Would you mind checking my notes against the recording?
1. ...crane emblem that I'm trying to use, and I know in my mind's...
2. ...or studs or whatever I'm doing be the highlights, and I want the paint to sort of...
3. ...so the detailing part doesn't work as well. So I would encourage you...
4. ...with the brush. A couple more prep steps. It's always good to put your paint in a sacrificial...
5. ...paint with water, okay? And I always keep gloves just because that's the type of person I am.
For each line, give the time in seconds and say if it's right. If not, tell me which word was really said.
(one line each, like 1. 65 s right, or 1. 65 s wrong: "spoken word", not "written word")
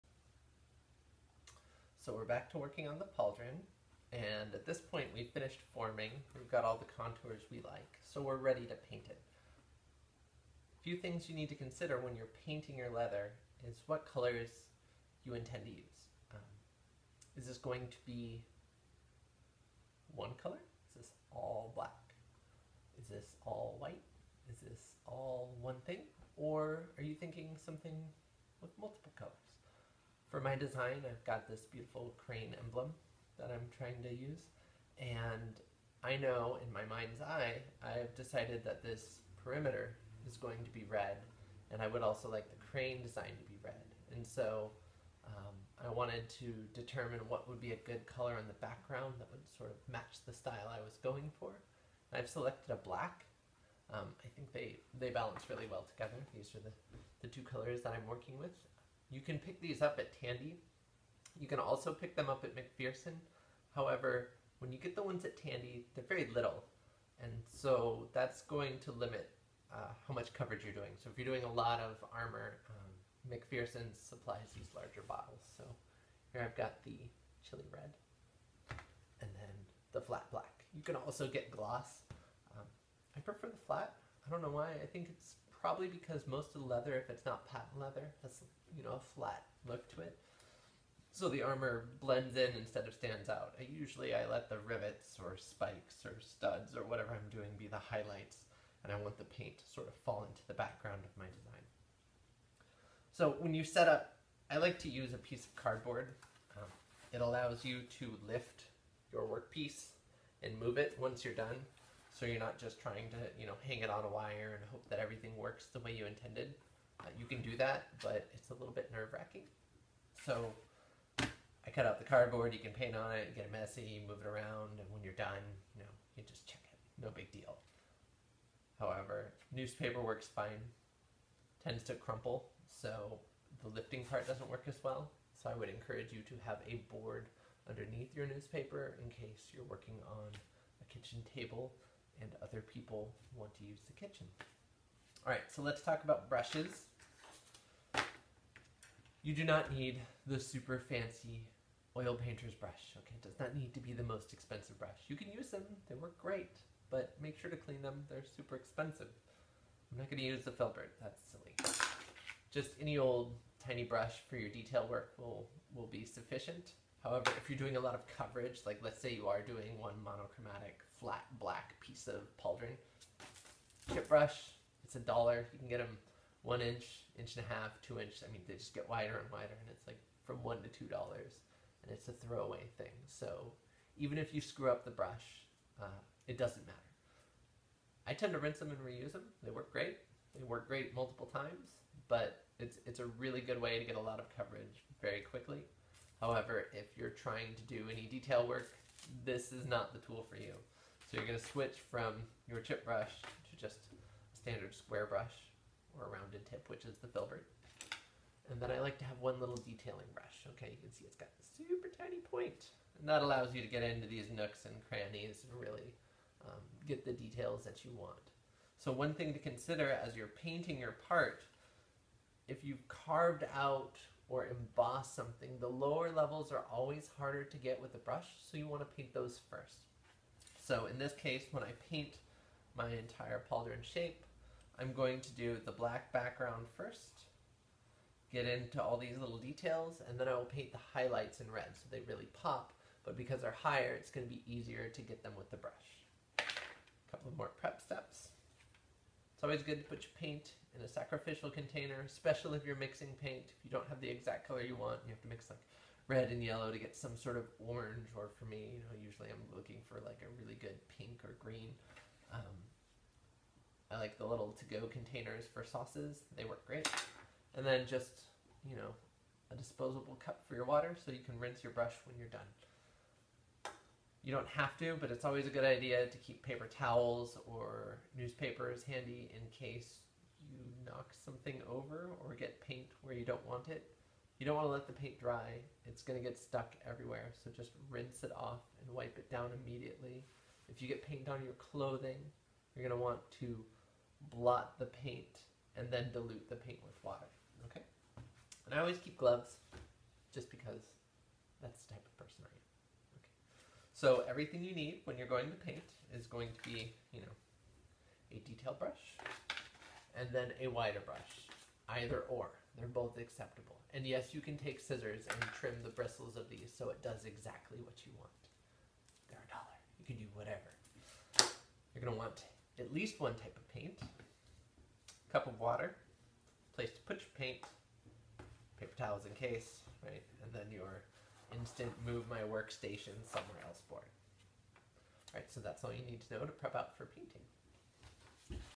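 1. 32 s right
2. 96 s right
3. 132 s wrong: "lifting", not "detailing"
4. 245 s right
5. 296 s right.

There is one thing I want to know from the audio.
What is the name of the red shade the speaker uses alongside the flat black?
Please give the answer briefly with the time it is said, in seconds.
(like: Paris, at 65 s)
Chili red, at 77 s.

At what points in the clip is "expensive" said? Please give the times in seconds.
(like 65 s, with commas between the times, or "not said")
154 s, 158 s.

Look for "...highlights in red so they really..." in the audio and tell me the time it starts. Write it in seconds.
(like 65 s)
240 s.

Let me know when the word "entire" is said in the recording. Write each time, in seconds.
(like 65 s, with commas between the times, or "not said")
232 s.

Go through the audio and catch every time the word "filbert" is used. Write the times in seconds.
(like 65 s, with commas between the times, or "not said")
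160 s, 207 s.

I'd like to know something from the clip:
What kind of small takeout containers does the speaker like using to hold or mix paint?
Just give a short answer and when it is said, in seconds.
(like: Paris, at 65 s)
To-go containers for sauces, at 264 s.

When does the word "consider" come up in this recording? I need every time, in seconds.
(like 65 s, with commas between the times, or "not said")
11 s, 219 s.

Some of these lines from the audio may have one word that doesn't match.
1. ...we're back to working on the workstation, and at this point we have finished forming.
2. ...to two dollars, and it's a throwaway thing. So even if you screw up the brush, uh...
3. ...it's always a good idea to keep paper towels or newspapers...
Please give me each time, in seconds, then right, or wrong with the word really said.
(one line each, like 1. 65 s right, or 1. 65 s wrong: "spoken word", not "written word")
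1. 2 s wrong: "pauldron", not "workstation"
2. 180 s right
3. 275 s right.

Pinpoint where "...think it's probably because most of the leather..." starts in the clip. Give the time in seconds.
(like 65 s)
84 s.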